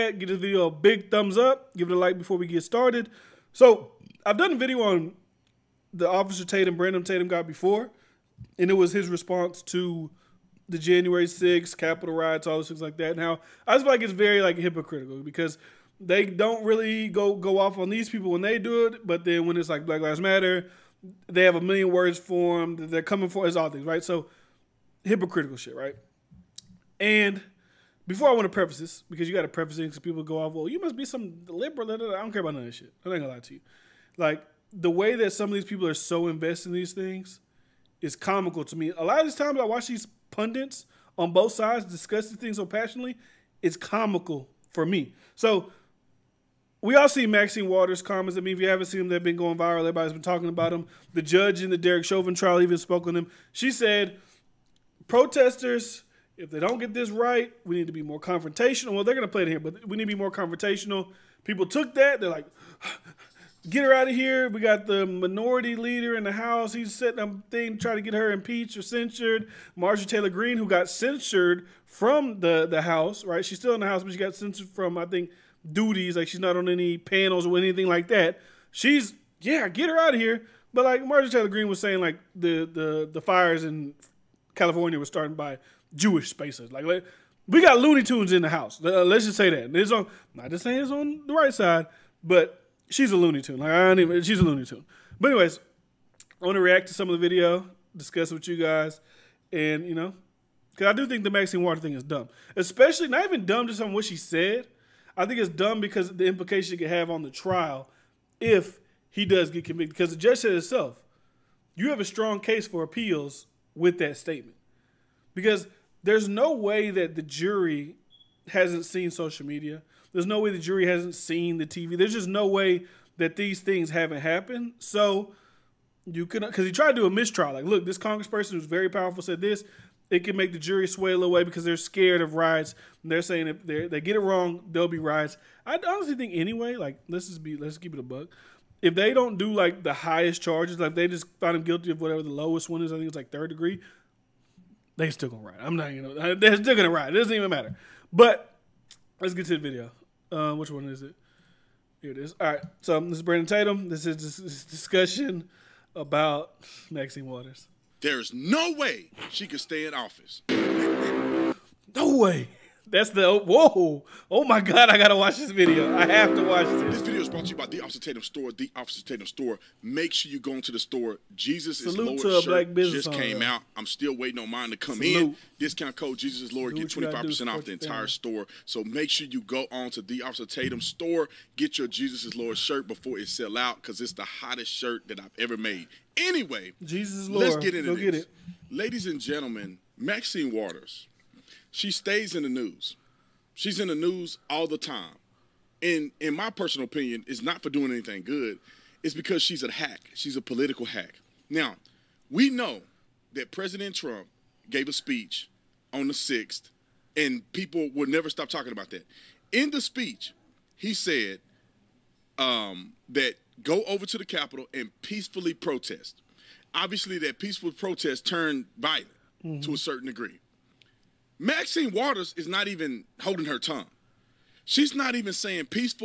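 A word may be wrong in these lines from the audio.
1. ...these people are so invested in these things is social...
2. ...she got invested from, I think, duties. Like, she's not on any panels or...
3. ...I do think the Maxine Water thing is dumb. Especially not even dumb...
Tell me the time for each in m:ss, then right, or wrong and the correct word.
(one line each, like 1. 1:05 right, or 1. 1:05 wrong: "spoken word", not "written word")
1. 0:35 wrong: "comical", not "social"
2. 1:14 wrong: "censured", not "invested"
3. 1:40 right.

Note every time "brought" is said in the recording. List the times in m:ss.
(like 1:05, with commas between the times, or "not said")
2:47.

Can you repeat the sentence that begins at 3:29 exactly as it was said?
In the speech, he said um, that go over to the Capitol and peacefully protest.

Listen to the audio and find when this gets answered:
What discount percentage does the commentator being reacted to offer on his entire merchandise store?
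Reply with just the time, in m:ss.
2:56.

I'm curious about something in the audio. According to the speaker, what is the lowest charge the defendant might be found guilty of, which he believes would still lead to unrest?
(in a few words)
third degree.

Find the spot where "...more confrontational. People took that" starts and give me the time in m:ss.
1:00.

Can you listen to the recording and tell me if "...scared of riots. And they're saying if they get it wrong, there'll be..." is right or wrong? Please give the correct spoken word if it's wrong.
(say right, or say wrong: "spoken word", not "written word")
right.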